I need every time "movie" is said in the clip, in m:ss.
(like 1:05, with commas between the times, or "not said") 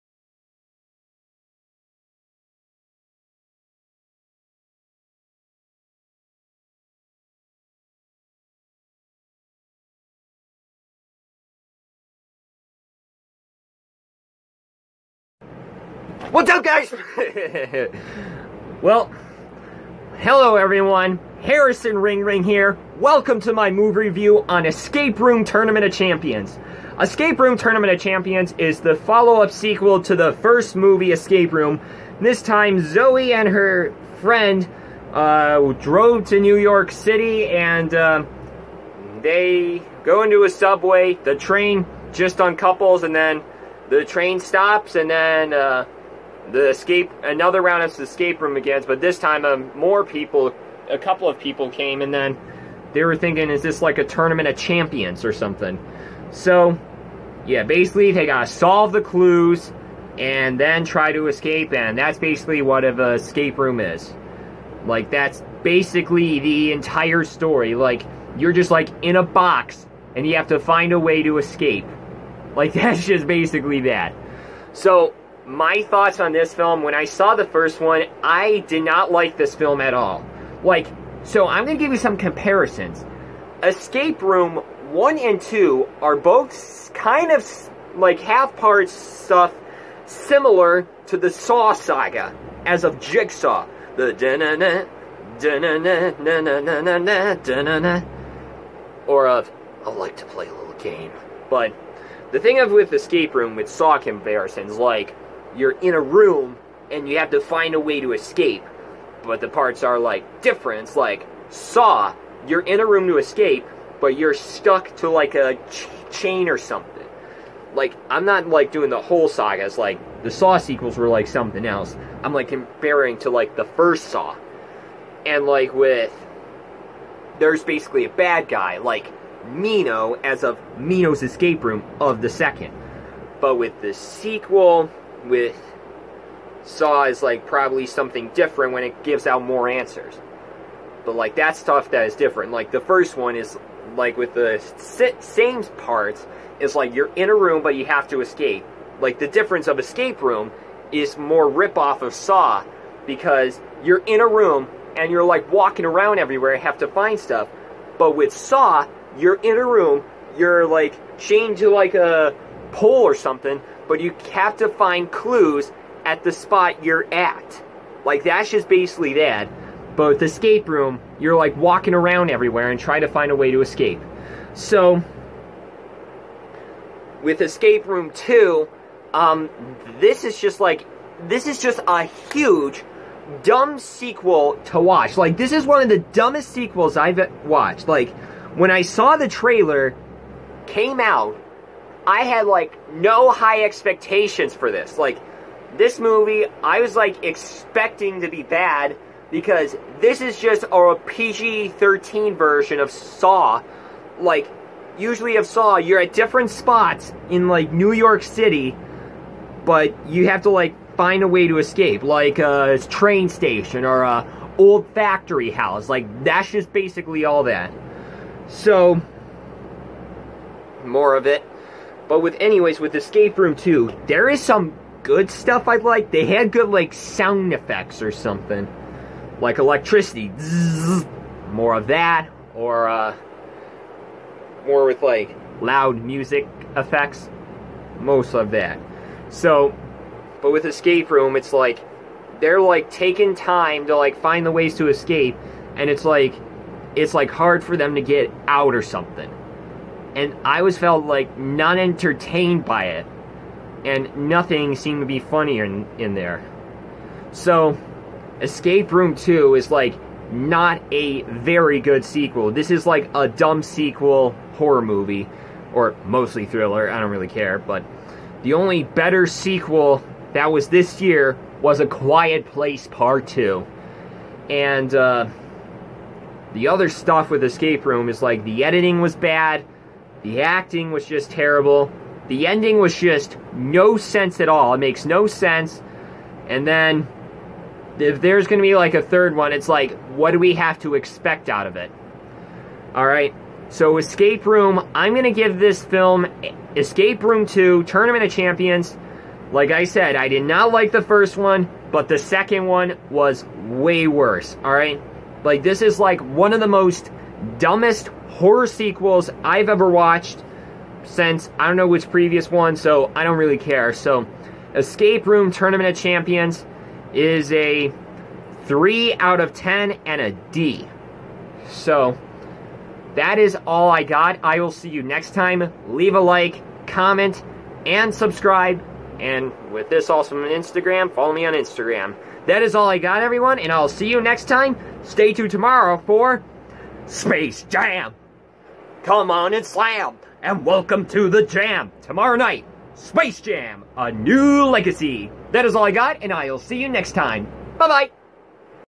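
0:23, 0:30, 3:15, 4:24.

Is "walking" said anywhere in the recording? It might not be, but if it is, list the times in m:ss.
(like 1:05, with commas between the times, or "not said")
2:35, 2:51.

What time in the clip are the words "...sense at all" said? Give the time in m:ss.
4:43.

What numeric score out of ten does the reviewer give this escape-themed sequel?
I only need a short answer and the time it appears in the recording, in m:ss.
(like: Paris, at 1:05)
3, at 5:18.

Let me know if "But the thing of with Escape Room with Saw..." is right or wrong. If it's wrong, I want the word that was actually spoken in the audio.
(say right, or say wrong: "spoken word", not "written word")
right.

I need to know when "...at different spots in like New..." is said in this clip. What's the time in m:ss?
3:26.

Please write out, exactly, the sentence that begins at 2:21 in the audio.
But like that stuff that is different.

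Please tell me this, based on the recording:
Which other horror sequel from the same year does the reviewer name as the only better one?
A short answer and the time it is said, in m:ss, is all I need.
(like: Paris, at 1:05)
A Quiet Place Part 2, at 4:31.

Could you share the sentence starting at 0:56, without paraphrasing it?
So, yeah, basically they gotta solve the clues and then try to escape, and that's basically what an escape room is.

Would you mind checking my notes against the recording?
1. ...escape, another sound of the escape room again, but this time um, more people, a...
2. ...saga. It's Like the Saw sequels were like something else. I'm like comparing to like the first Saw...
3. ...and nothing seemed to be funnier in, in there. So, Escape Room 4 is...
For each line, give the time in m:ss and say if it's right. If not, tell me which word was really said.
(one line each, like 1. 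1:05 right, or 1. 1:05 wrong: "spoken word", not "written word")
1. 0:46 wrong: "round", not "sound"
2. 1:59 right
3. 4:13 wrong: "2", not "4".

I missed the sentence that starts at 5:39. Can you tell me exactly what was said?
Come on and slam, and welcome to the jam.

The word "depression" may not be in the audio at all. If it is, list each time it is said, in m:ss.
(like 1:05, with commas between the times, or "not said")
not said.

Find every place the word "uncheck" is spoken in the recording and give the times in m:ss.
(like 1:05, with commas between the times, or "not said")
not said.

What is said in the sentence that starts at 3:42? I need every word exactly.
But with anyways, with Escape Room 2, there is some good stuff I like.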